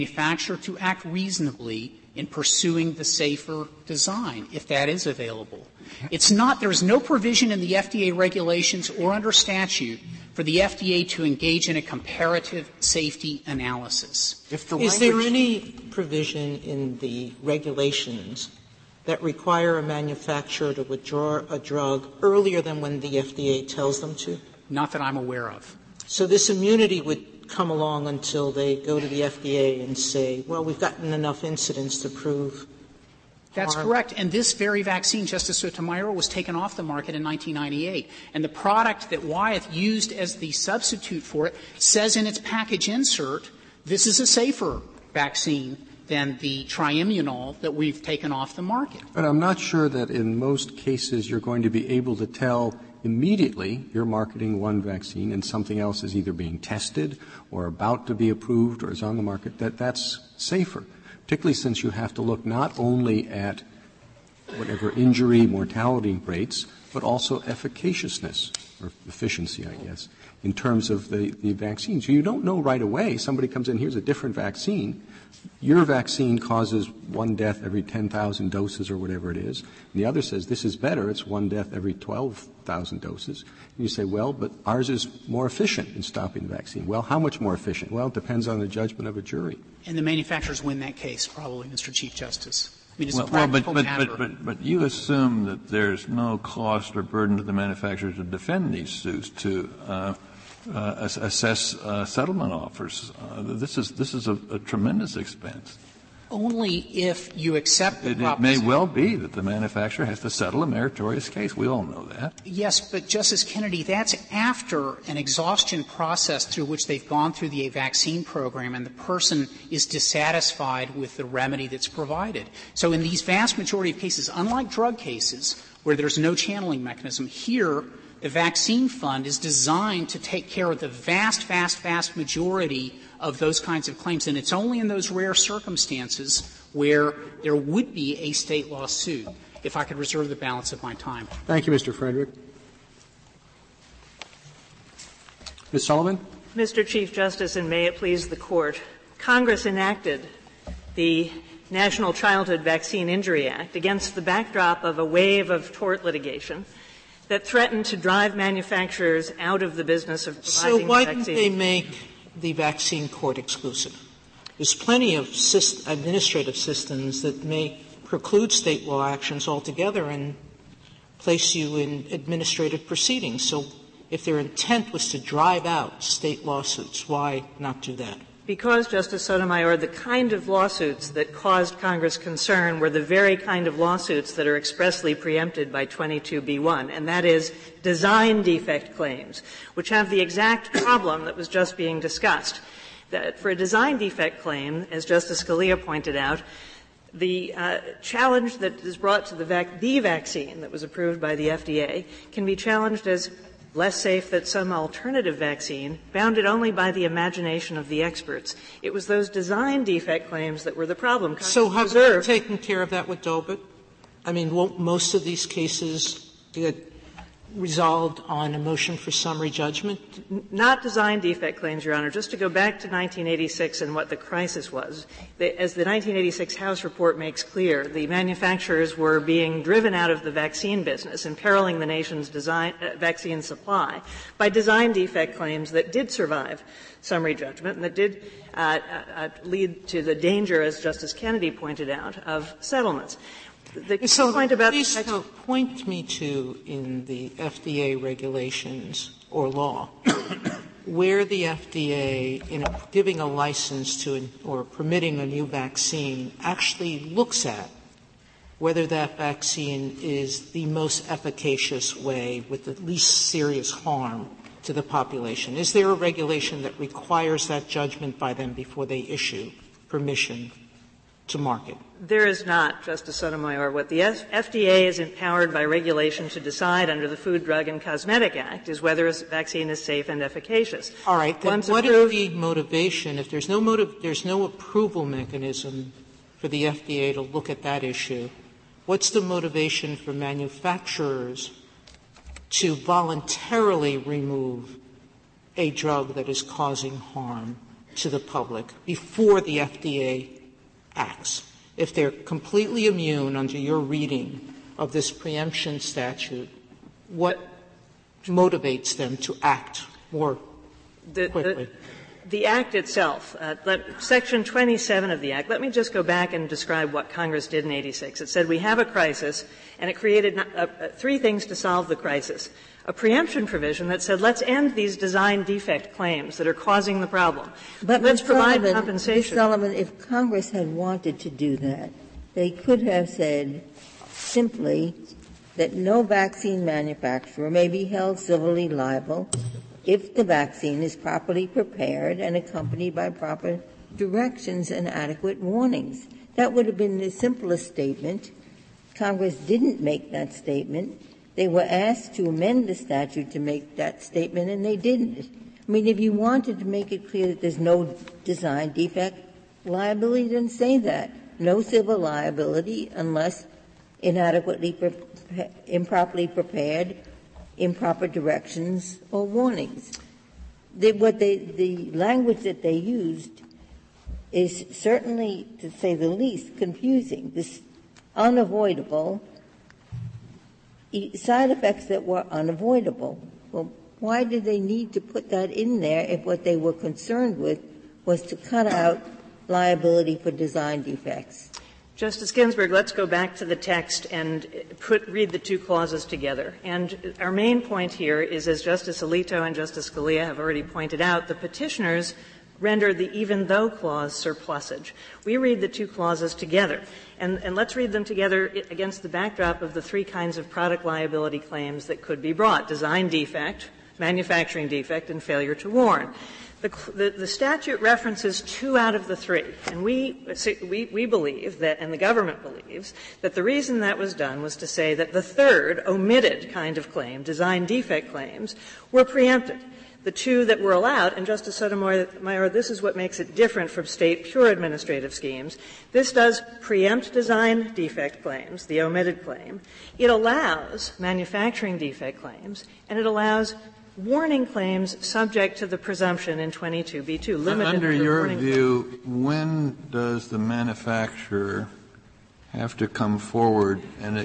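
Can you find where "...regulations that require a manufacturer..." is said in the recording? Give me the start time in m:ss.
0:17.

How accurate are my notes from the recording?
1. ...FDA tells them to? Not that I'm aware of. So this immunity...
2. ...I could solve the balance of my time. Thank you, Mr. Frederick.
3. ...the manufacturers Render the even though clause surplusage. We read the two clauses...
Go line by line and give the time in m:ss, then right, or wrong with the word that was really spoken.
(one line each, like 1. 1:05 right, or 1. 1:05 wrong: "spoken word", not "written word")
1. 0:23 right
2. 2:19 wrong: "reserve", not "solve"
3. 6:41 wrong: "petitioners", not "manufacturers".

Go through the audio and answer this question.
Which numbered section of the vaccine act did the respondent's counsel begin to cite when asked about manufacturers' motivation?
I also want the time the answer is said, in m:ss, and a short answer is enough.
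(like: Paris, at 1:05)
Section 27, at 5:14.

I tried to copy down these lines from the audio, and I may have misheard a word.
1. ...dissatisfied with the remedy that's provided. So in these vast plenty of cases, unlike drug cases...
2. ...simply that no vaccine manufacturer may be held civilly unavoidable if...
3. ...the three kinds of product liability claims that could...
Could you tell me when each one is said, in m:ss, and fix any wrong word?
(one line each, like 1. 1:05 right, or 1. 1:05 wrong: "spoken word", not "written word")
1. 1:59 wrong: "majority", not "plenty"
2. 5:34 wrong: "liable", not "unavoidable"
3. 6:49 right.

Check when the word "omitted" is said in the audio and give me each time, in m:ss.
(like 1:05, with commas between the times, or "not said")
7:05, 7:18.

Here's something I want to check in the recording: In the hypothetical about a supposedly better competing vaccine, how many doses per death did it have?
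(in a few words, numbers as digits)
12,000.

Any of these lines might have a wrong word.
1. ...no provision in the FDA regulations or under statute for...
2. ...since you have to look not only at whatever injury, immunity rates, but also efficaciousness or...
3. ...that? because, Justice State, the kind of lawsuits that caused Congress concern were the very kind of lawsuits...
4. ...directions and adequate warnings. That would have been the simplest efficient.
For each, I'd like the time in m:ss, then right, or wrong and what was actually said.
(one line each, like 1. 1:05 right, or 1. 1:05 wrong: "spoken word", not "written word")
1. 0:06 right
2. 1:01 wrong: "mortality", not "immunity"
3. 2:57 wrong: "Sotomayor", not "State"
4. 5:43 wrong: "statement", not "efficient".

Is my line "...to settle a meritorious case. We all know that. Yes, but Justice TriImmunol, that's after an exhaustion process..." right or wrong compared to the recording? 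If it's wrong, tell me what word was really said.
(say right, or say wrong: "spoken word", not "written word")
wrong: "Kennedy", not "TriImmunol".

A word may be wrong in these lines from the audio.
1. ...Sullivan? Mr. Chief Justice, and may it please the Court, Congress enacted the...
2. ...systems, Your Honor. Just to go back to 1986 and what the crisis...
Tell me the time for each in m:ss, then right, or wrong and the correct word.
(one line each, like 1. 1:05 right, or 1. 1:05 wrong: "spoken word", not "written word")
1. 2:25 right
2. 3:41 wrong: "claims", not "systems".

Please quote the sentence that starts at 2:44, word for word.
There's plenty of syst- administrative systems that may preclude state law actions altogether and place you in administrative proceedings.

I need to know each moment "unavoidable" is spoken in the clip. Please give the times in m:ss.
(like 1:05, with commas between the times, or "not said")
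6:18, 6:22.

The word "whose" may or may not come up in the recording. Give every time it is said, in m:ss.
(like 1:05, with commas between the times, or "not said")
not said.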